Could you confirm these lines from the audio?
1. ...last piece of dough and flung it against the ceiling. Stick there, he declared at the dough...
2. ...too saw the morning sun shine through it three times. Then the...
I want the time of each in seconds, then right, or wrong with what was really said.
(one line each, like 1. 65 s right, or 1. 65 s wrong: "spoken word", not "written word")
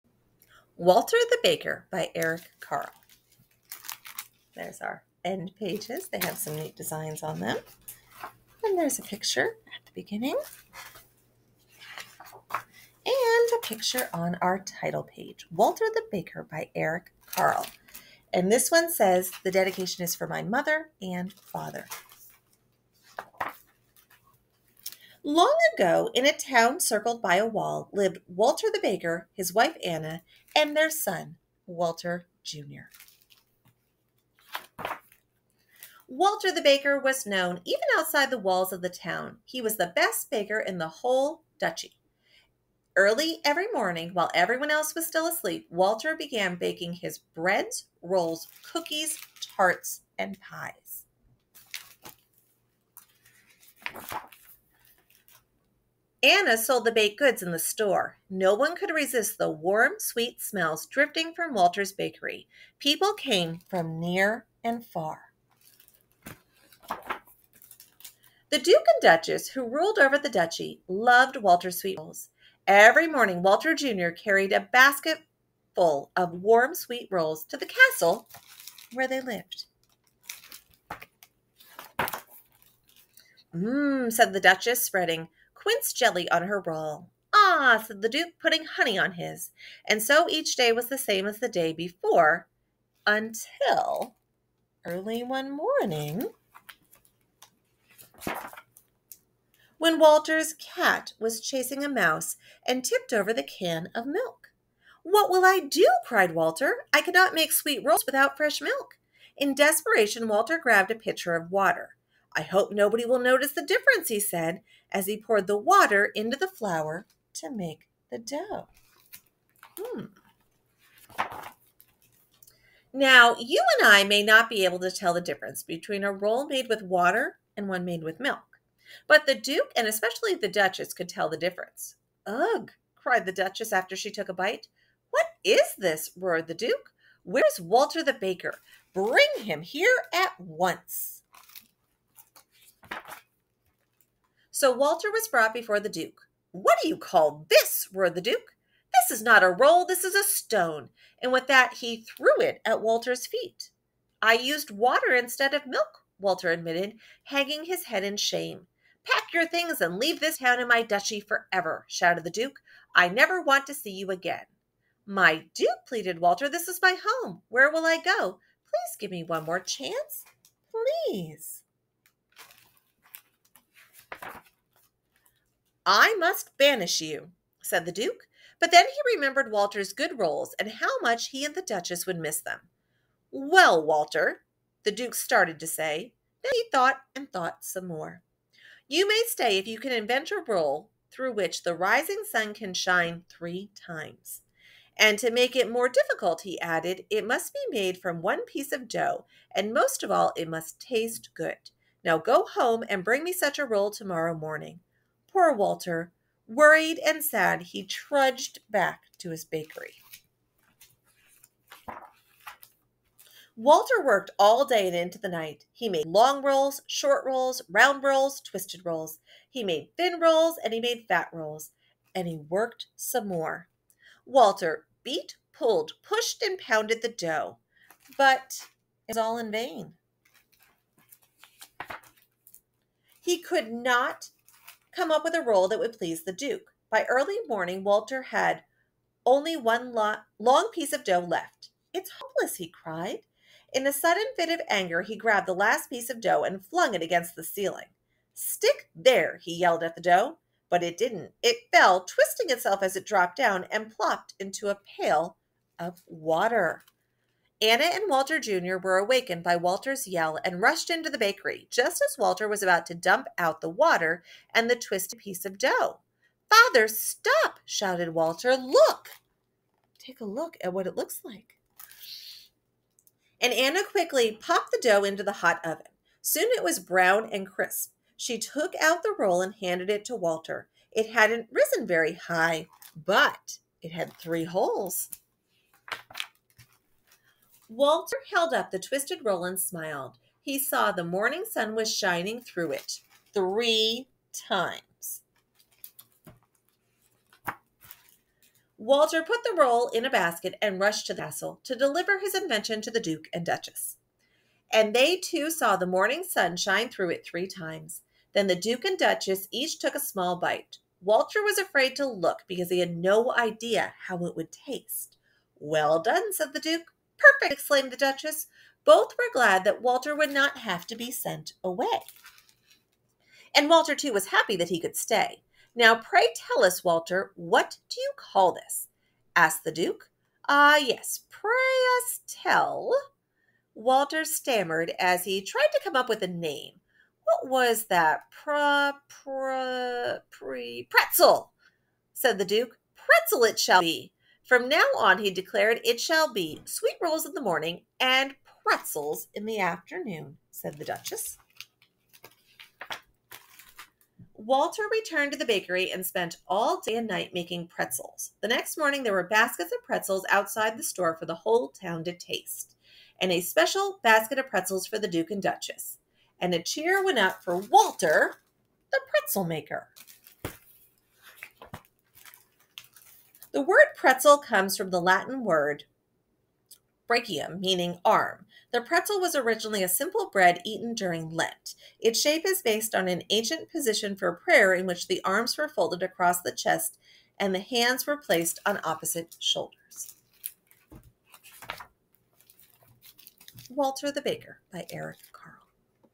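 1. 245 s wrong: "yelled", not "declared"
2. 305 s right.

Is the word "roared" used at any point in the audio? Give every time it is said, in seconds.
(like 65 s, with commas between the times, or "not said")
136 s, 147 s.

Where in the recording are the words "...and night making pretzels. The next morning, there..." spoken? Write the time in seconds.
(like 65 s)
356 s.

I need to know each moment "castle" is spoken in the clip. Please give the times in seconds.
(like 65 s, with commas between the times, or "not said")
77 s, 301 s.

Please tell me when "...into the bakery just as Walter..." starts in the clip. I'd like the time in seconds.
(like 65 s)
260 s.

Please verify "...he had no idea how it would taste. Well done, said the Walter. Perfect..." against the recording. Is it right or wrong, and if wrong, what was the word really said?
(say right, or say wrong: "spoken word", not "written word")
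wrong: "Duke", not "Walter".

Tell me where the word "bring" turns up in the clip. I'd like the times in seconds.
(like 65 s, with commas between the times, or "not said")
138 s, 203 s.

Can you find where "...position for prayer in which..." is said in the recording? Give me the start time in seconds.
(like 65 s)
383 s.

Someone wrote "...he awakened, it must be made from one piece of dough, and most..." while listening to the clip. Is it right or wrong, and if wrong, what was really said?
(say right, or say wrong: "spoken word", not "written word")
wrong: "added", not "awakened".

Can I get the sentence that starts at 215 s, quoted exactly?
He made long rolls, short rolls, round rolls, twisted rolls.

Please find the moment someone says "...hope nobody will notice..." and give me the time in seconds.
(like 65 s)
112 s.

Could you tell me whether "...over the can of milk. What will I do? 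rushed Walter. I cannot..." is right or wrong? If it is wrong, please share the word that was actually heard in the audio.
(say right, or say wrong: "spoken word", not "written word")
wrong: "cried", not "rushed".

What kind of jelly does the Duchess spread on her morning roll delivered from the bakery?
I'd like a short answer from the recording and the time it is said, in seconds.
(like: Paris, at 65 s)
quince jelly, at 85 s.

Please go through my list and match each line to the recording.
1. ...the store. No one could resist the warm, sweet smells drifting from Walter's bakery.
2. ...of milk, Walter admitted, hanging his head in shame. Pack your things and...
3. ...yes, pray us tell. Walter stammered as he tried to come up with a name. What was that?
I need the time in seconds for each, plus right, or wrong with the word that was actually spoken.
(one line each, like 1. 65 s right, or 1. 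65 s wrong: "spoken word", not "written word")
1. 57 s right
2. 155 s right
3. 330 s right.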